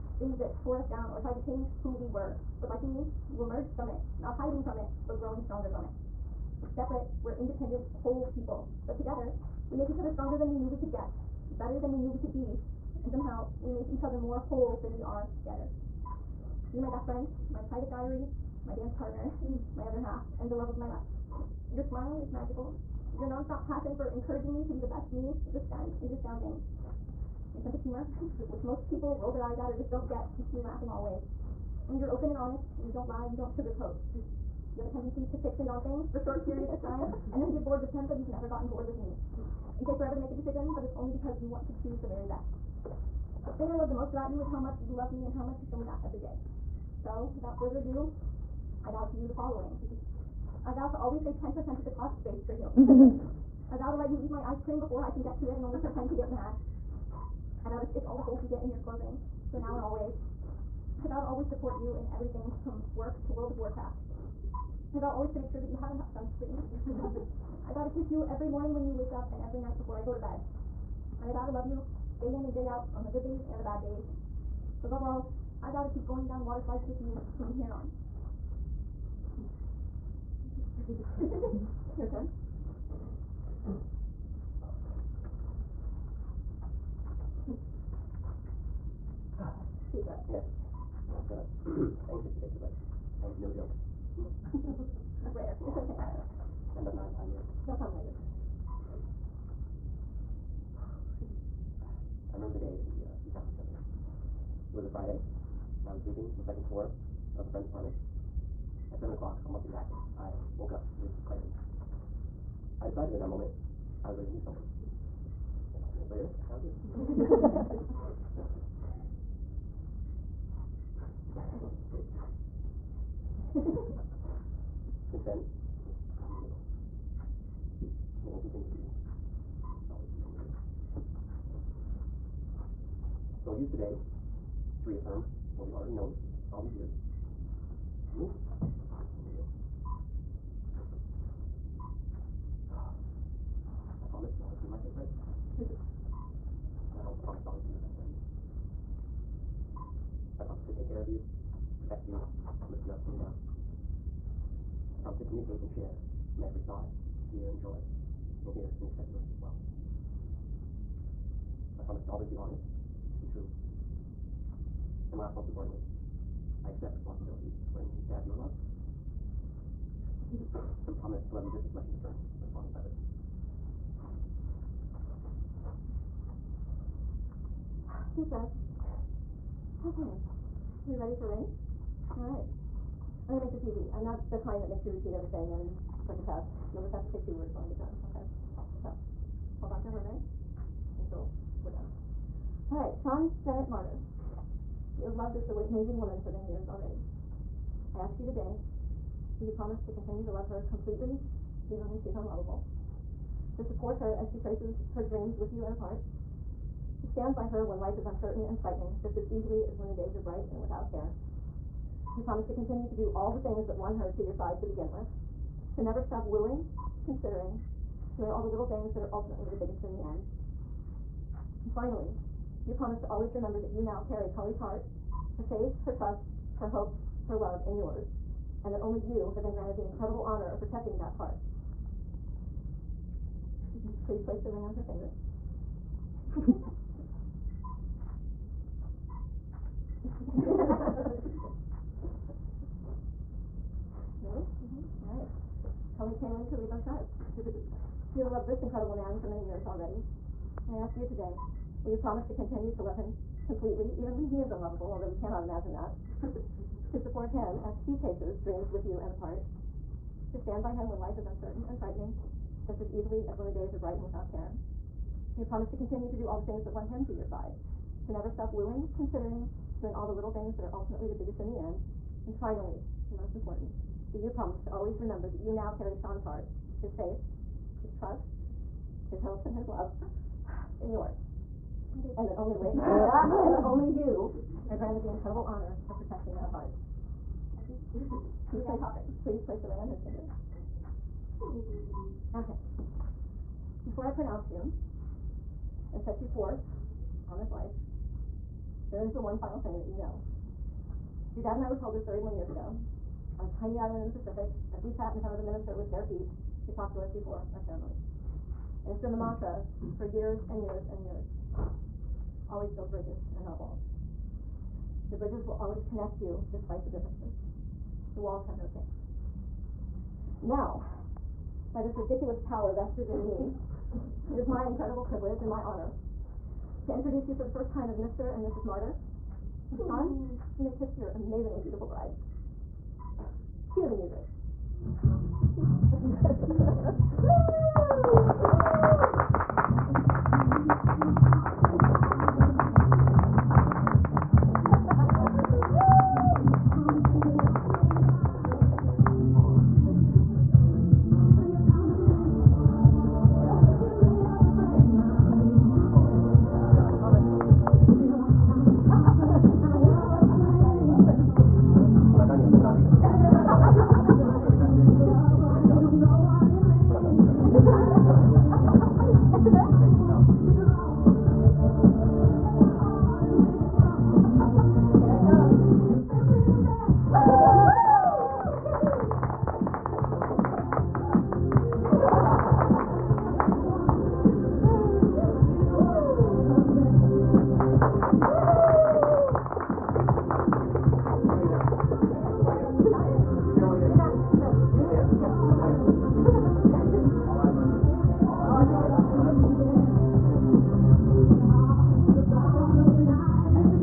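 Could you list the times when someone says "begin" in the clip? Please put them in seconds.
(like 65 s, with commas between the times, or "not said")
214 s.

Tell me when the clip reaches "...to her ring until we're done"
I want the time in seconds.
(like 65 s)
189 s.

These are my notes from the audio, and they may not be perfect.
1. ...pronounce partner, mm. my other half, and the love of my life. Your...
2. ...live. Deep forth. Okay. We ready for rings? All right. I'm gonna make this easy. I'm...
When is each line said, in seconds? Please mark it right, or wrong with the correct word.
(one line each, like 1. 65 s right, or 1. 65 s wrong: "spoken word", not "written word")
1. 18 s wrong: "dance", not "pronounce"
2. 172 s wrong: "breath", not "forth".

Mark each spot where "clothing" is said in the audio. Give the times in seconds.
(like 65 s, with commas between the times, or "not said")
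58 s.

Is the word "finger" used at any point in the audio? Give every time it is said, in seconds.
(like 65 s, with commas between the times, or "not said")
236 s, 290 s.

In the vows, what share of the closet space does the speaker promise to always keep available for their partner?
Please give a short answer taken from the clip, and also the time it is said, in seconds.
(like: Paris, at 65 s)
10%, at 51 s.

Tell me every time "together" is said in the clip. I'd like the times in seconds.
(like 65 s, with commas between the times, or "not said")
8 s, 15 s.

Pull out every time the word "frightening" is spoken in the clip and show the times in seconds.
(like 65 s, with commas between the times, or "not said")
208 s, 261 s.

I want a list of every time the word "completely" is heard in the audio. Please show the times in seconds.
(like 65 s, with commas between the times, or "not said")
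200 s, 253 s.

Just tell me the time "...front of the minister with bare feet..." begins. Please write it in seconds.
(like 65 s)
305 s.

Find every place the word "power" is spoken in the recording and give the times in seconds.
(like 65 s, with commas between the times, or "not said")
322 s.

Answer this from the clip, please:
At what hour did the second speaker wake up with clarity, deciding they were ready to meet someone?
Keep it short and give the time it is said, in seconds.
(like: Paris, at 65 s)
7 o'clock, at 108 s.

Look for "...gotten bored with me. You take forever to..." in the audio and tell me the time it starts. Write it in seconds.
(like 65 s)
38 s.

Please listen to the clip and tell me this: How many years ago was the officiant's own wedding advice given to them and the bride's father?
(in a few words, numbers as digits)
31.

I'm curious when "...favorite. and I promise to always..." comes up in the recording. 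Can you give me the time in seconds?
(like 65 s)
144 s.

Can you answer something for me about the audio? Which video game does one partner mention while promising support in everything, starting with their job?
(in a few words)
World of Warcraft.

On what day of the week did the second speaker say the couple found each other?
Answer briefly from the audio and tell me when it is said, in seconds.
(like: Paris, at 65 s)
Friday, at 104 s.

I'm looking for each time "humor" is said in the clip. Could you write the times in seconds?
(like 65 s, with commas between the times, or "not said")
27 s.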